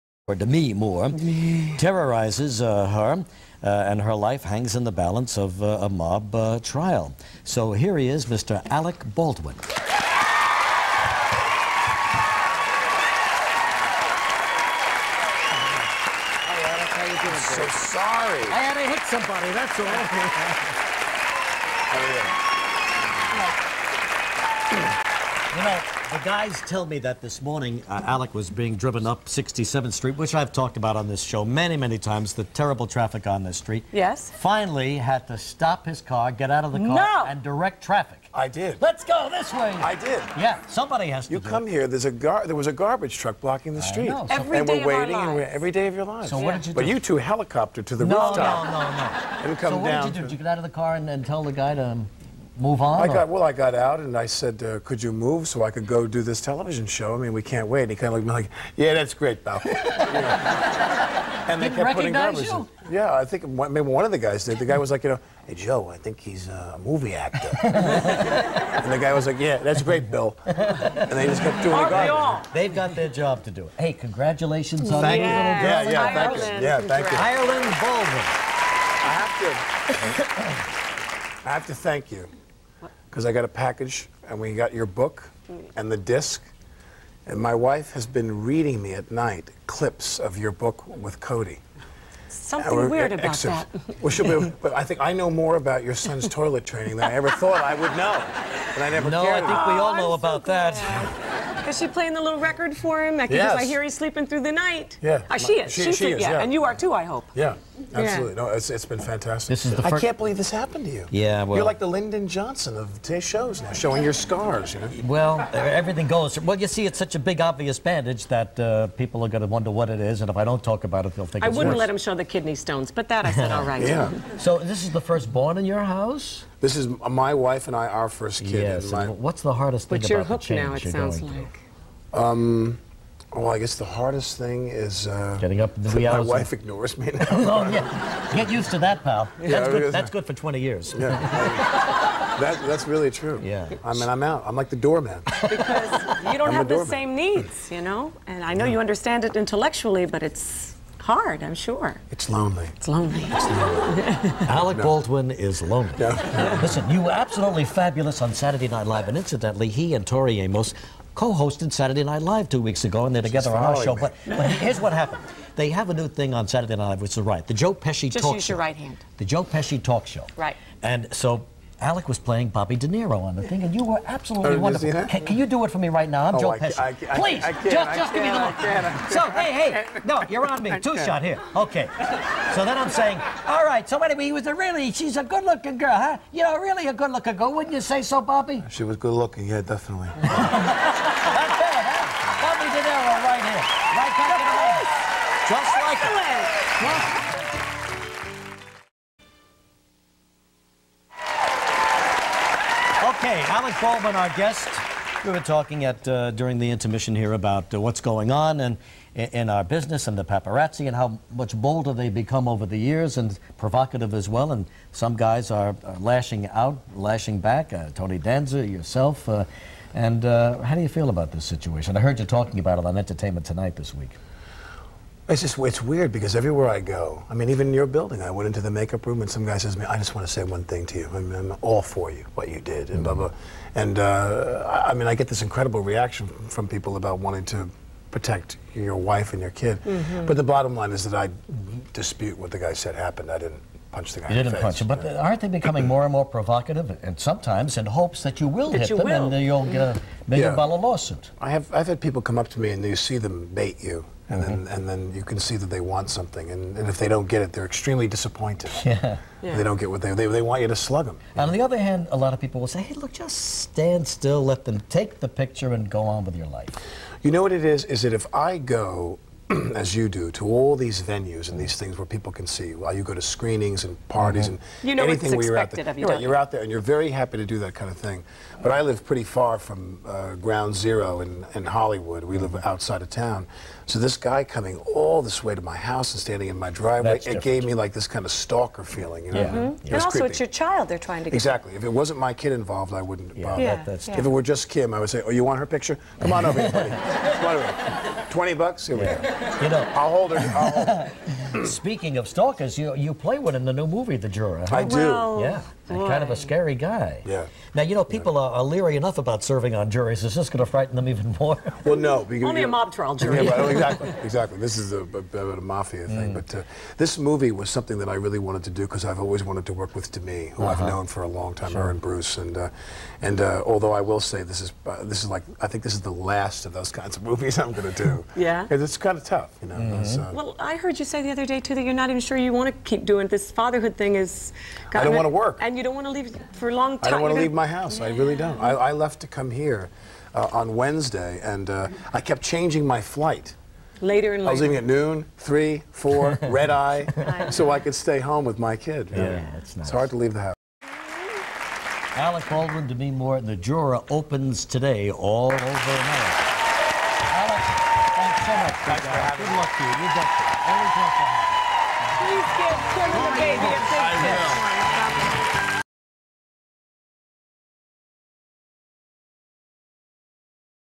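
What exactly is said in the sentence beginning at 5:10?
Is this going to frighten them even more?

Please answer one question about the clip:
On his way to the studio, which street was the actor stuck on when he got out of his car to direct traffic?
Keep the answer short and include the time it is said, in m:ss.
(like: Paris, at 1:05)
67th Street, at 0:29.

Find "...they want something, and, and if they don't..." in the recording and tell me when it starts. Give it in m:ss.
4:15.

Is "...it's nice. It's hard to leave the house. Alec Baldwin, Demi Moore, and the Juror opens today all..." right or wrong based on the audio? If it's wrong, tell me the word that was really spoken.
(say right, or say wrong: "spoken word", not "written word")
right.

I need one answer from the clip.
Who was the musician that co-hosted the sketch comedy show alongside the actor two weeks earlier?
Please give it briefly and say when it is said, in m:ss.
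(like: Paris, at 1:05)
Tori Amos, at 2:40.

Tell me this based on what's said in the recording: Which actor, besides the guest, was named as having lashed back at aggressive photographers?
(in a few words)
Tony Danza.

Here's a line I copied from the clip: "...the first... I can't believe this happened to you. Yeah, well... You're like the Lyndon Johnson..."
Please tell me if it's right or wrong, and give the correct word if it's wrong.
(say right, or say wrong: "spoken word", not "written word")
right.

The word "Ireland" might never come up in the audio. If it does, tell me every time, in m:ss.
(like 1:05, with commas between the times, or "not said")
1:17.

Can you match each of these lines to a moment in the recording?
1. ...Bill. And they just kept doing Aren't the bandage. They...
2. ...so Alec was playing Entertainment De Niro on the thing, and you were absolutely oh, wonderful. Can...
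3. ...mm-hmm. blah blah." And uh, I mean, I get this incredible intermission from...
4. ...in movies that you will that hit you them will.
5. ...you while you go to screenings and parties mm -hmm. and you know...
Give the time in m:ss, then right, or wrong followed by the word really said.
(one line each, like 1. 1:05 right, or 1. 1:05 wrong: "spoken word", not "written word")
1. 1:10 wrong: "garbage", not "bandage"
2. 2:51 wrong: "Bobby", not "Entertainment"
3. 3:53 wrong: "reaction", not "intermission"
4. 4:07 wrong: "hopes", not "movies"
5. 4:32 right.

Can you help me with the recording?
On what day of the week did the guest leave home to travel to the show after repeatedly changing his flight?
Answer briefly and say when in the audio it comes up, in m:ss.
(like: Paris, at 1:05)
Wednesday, at 5:40.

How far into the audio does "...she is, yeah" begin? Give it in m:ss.
1:45.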